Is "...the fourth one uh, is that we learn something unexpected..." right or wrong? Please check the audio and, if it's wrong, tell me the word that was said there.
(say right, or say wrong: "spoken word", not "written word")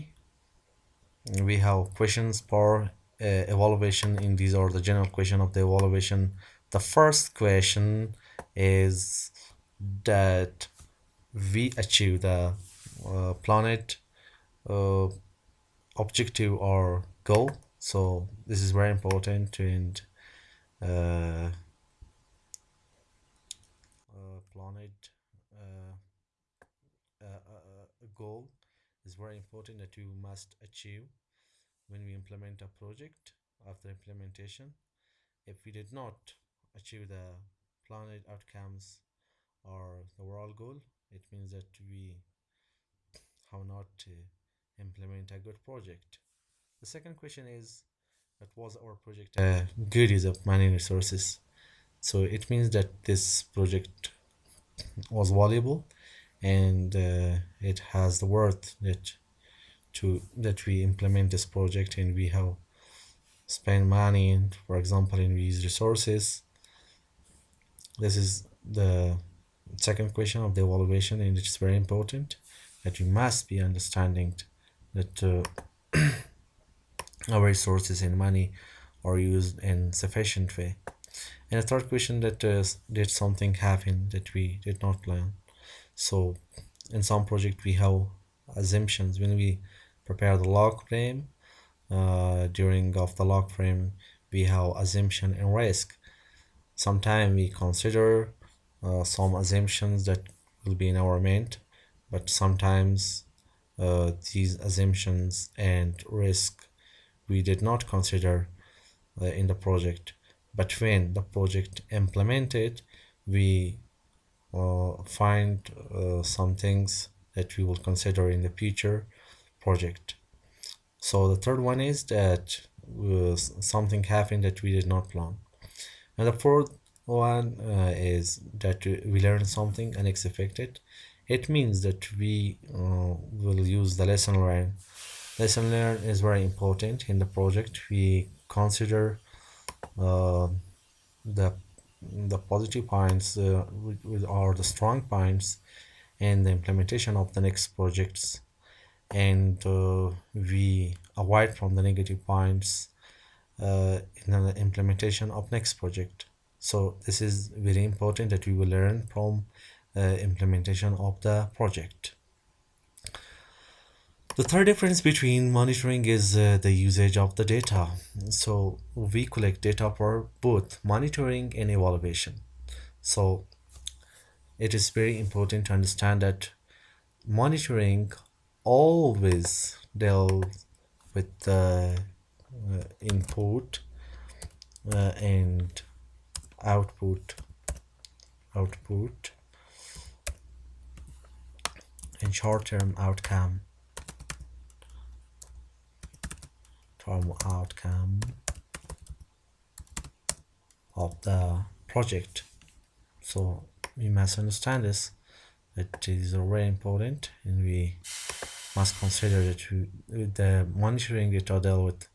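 right.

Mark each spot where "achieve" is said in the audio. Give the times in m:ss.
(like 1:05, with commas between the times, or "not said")
0:11, 0:30, 0:36.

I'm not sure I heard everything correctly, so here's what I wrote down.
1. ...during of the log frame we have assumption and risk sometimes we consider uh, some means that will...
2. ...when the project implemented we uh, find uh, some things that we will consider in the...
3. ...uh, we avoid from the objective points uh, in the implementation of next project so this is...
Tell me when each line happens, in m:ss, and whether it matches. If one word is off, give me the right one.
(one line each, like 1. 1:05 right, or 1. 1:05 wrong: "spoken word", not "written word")
1. 1:32 wrong: "assumptions", not "means"
2. 1:50 right
3. 2:29 wrong: "negative", not "objective".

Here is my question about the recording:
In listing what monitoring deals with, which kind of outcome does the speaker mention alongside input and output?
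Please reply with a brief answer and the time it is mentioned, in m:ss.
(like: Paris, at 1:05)
short-term outcome, at 3:12.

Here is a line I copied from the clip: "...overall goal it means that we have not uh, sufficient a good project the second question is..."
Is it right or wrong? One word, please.
wrong.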